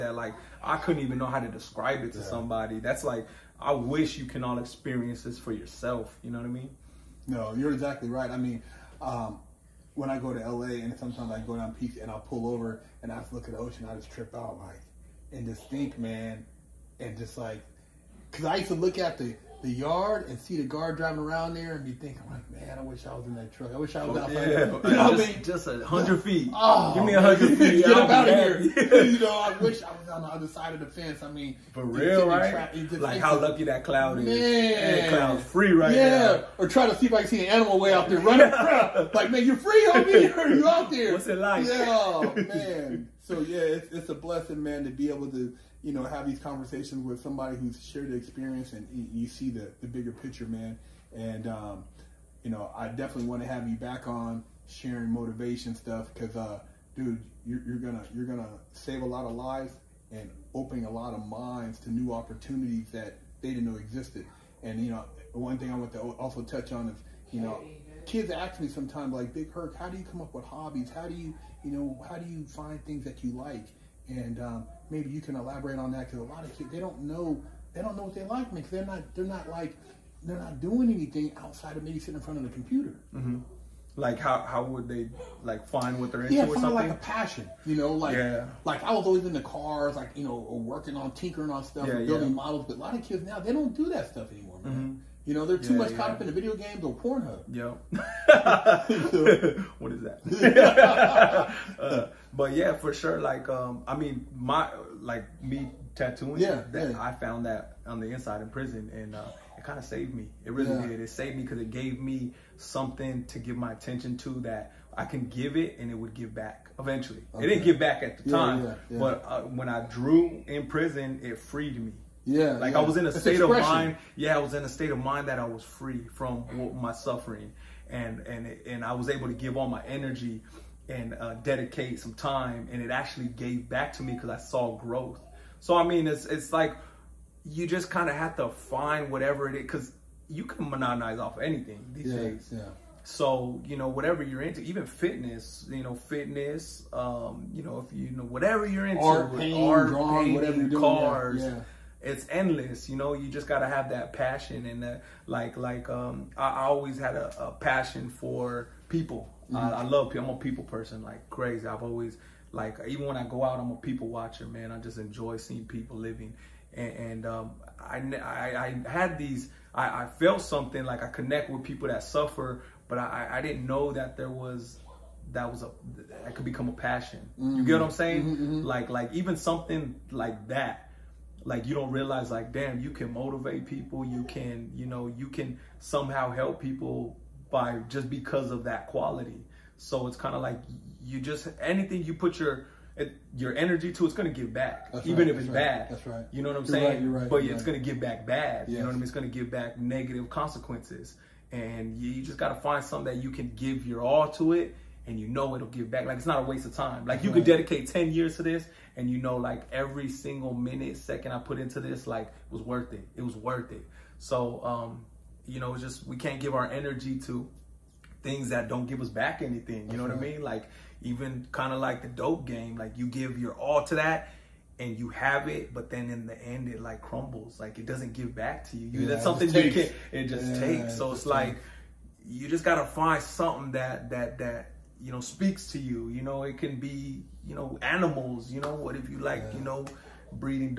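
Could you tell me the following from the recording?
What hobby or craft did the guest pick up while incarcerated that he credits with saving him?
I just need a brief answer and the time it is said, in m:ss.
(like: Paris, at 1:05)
tattooing, at 1:45.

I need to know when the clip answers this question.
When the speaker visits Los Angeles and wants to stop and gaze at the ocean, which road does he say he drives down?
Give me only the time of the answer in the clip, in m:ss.
0:11.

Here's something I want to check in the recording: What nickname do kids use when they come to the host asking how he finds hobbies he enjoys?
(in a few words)
Big Herc.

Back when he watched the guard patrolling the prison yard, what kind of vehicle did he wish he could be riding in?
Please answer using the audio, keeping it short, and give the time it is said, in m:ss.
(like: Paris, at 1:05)
truck, at 0:23.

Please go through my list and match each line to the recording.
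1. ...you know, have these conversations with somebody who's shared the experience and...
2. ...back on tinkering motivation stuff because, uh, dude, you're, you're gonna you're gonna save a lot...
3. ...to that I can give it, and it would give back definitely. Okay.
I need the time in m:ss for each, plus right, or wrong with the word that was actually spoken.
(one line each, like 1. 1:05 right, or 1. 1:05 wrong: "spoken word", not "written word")
1. 0:45 right
2. 0:53 wrong: "sharing", not "tinkering"
3. 1:54 wrong: "eventually", not "definitely".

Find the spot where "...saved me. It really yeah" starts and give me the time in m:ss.
1:49.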